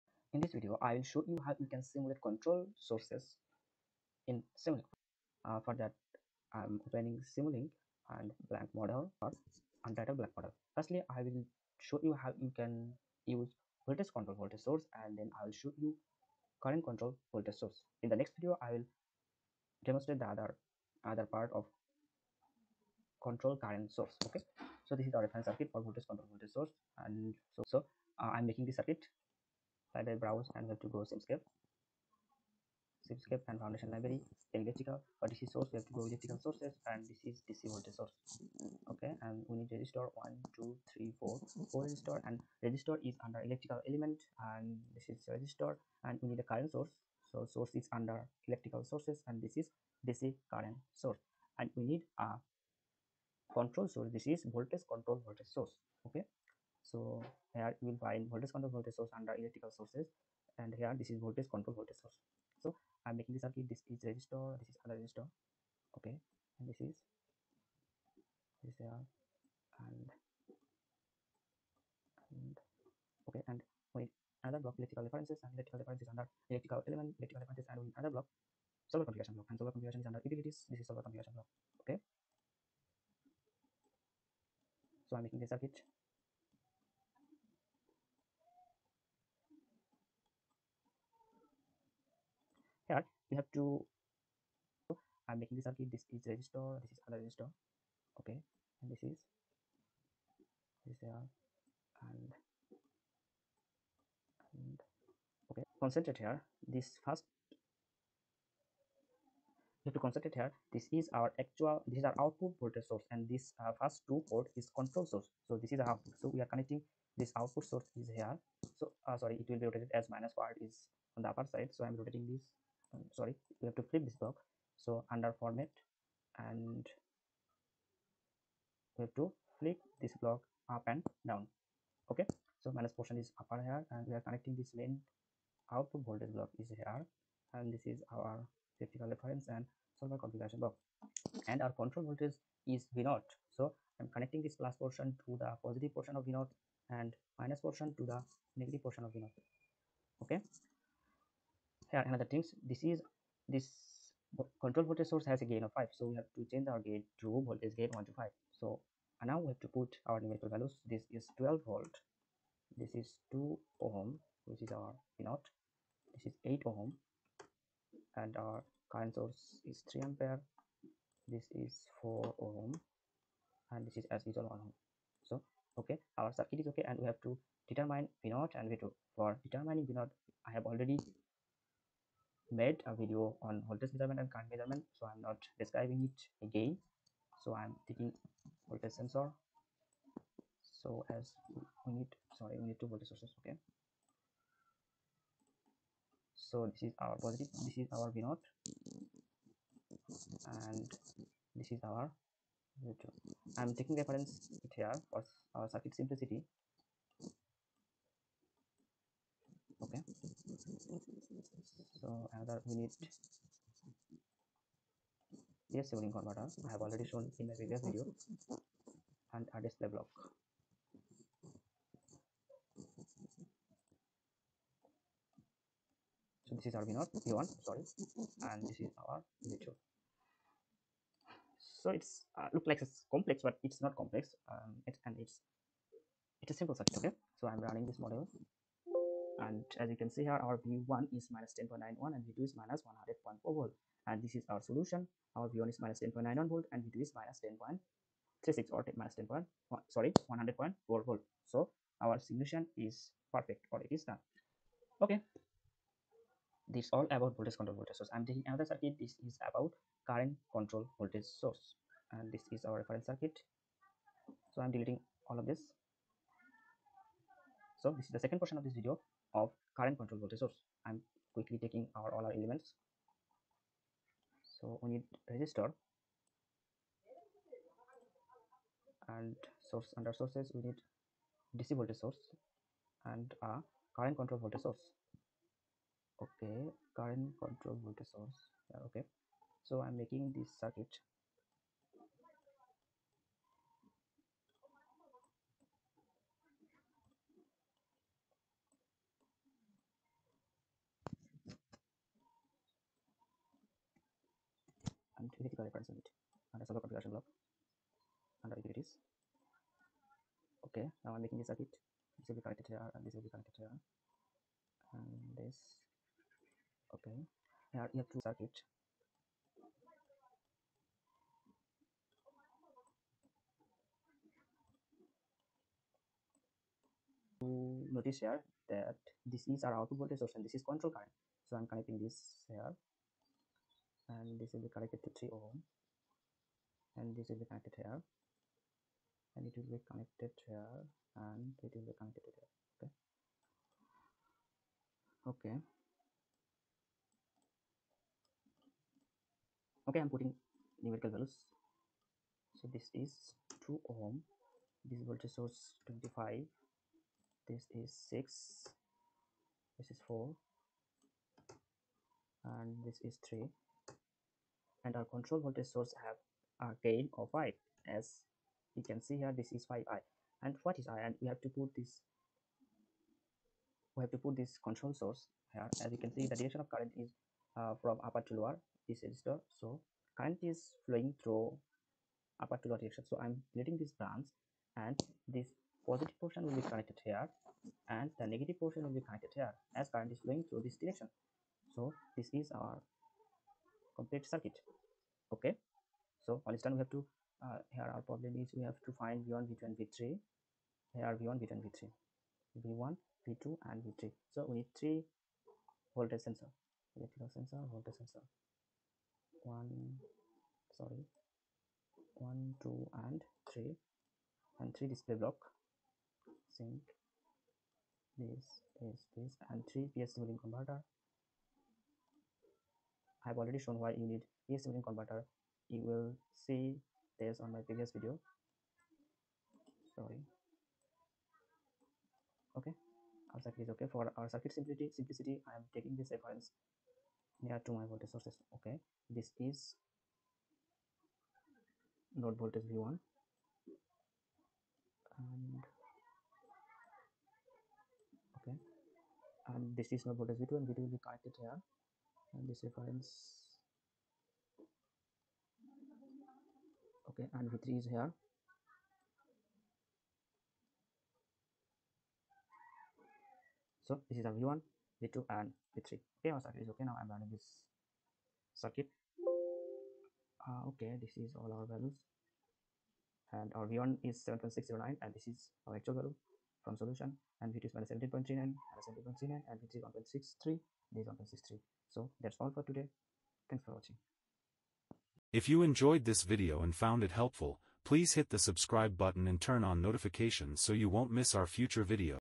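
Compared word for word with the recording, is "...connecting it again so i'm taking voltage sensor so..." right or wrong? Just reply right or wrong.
wrong.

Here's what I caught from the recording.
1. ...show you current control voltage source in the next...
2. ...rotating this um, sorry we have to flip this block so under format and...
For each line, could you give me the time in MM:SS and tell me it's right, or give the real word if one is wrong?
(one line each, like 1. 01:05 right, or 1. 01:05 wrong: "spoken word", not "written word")
1. 00:15 right
2. 02:01 right.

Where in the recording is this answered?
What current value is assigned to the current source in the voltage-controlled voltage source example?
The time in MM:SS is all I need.
02:49.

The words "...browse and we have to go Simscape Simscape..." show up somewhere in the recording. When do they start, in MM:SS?
00:30.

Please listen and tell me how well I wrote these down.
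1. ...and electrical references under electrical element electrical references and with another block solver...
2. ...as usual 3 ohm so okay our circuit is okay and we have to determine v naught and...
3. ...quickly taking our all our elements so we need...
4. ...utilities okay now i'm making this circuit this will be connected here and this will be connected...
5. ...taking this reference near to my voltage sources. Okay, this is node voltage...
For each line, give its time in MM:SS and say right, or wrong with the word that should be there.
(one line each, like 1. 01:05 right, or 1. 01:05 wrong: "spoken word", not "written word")
1. 01:15 right
2. 02:54 wrong: "1", not "3"
3. 04:31 right
4. 05:08 right
5. 07:15 right.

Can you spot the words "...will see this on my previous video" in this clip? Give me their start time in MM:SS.
07:05.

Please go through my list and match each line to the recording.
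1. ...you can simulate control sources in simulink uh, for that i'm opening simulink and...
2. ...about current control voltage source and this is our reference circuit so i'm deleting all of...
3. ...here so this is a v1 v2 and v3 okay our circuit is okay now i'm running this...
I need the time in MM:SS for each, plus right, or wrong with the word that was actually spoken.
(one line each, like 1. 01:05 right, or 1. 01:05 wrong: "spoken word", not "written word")
1. 00:01 right
2. 04:19 right
3. 07:37 right.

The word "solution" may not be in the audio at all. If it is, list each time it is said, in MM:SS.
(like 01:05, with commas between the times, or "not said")
04:04, 04:12, 07:56.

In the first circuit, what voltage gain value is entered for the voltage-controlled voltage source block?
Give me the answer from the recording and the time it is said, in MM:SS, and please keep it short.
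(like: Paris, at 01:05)
5, at 02:37.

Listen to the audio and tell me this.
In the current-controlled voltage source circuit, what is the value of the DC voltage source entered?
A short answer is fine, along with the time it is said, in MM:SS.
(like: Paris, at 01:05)
25, at 05:55.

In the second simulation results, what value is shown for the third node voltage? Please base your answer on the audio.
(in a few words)
1.63.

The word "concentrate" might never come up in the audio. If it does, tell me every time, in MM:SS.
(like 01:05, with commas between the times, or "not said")
01:45, 01:49.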